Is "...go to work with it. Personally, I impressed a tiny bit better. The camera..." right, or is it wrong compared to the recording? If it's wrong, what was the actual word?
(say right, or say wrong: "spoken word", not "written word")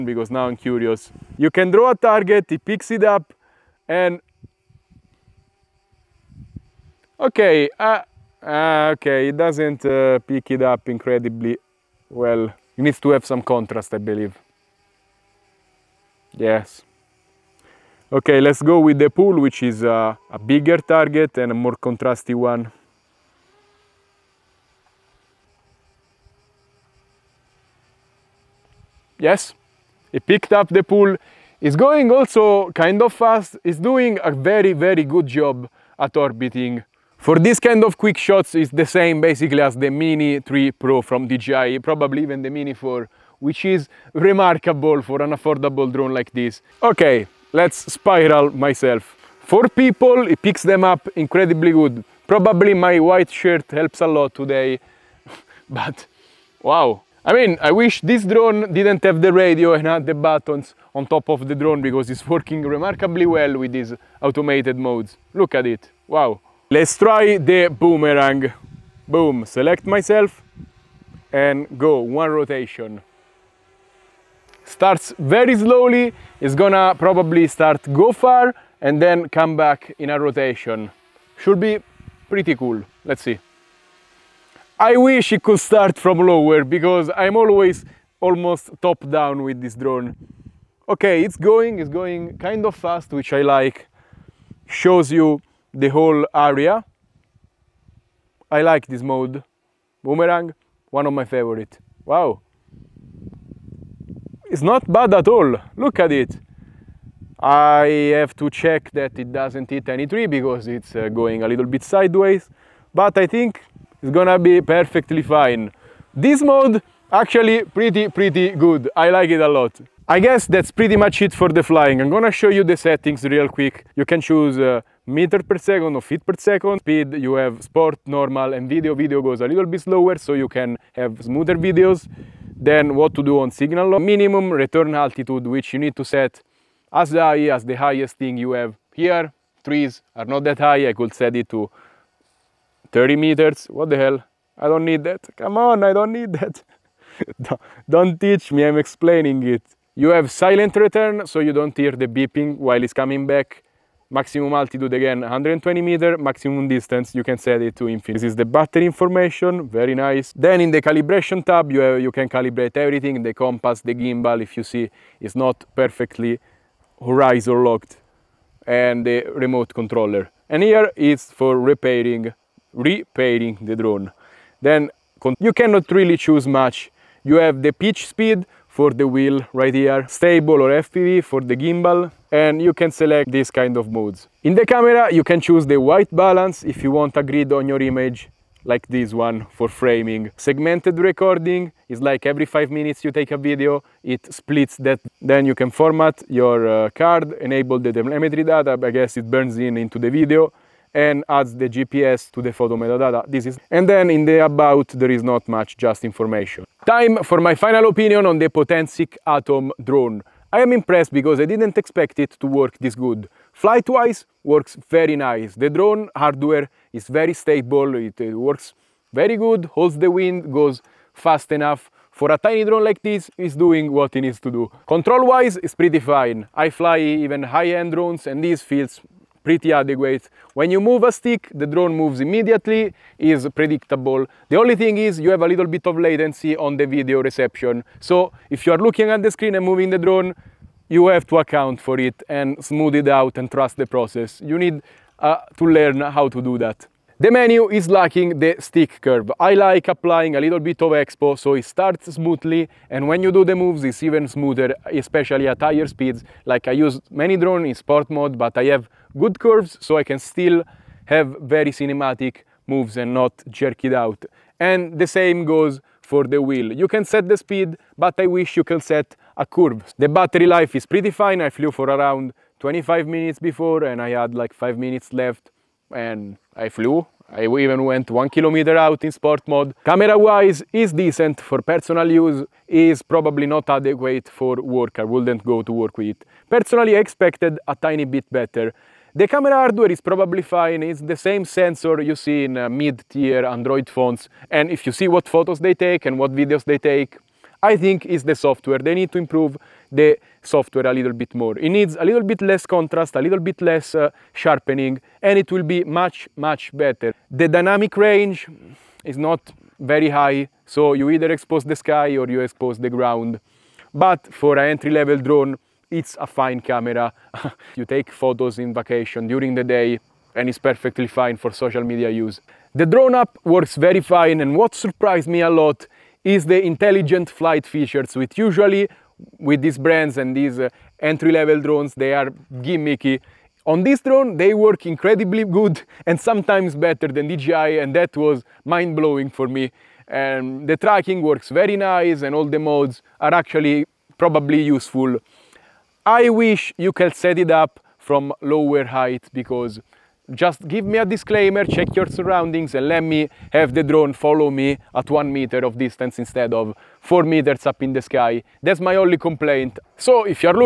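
wrong: "expected", not "impressed".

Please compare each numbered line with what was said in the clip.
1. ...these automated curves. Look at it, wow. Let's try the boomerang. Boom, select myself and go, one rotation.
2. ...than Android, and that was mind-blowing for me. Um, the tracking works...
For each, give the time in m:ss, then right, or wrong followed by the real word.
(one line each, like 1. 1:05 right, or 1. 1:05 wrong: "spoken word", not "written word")
1. 1:03 wrong: "modes", not "curves"
2. 5:37 wrong: "DJI", not "Android".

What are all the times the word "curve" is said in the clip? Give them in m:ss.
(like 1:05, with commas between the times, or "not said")
4:09, 4:19, 4:29.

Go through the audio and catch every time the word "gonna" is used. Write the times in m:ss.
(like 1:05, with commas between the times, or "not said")
1:16, 1:54, 2:02.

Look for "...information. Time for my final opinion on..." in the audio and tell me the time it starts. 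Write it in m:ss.
3:26.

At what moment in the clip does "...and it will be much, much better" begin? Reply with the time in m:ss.
5:05.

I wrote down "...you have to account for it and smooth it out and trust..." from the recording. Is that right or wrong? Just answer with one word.
right.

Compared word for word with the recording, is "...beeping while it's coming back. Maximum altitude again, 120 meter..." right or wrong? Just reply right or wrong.
right.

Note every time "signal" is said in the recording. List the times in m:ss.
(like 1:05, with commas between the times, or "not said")
2:13.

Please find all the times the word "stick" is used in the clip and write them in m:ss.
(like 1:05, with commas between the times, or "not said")
3:51, 4:08.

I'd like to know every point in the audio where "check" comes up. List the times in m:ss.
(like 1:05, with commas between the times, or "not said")
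1:48, 5:51.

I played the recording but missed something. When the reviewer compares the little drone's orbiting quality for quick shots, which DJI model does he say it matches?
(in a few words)
Mini 3 Pro.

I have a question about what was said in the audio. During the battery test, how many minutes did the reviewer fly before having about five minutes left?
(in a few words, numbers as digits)
25 minutes.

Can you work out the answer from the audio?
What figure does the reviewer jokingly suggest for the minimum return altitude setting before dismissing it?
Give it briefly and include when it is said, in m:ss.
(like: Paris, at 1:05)
30 meters, at 2:22.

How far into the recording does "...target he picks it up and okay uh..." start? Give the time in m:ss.
0:01.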